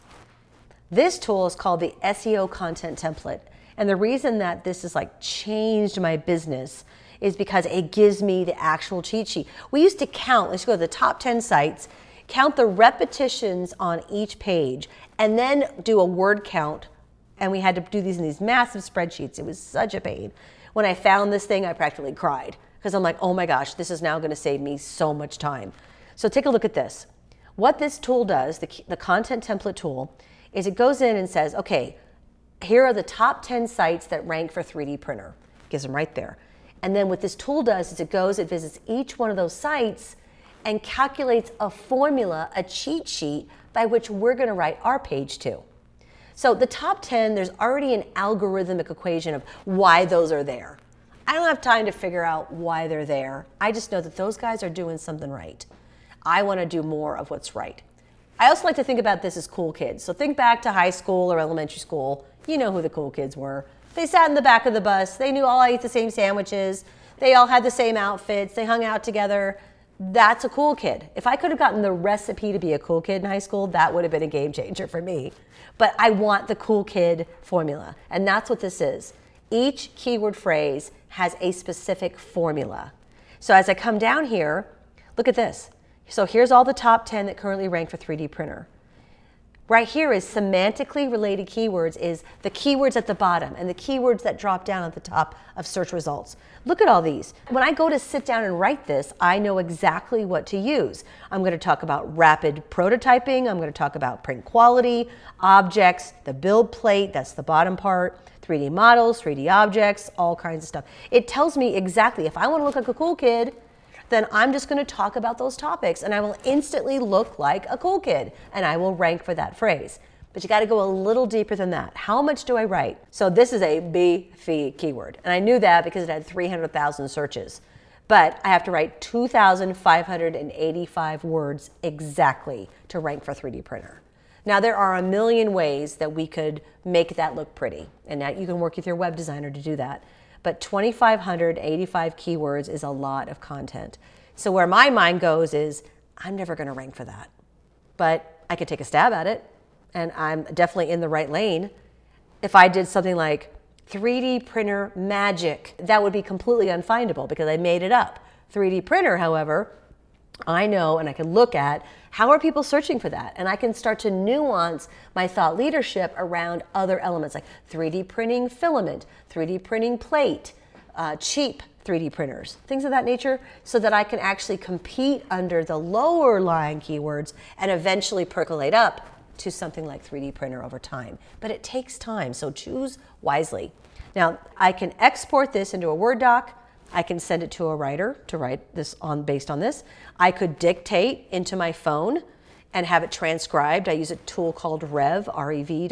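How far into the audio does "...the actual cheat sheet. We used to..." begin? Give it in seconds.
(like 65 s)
8 s.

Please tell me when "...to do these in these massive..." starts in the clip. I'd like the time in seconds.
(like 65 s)
17 s.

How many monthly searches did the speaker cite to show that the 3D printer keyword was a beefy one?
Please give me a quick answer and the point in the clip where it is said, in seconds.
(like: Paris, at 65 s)
300,000, at 126 s.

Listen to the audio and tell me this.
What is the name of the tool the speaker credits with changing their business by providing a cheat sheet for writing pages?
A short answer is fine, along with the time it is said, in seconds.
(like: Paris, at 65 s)
SEO content template, at 2 s.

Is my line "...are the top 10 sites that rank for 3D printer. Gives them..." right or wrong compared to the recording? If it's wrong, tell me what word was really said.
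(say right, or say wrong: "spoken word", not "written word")
right.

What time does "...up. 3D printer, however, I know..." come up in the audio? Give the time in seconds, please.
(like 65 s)
157 s.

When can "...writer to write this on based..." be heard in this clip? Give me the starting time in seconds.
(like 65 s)
187 s.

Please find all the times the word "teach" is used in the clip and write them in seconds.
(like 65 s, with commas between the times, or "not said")
not said.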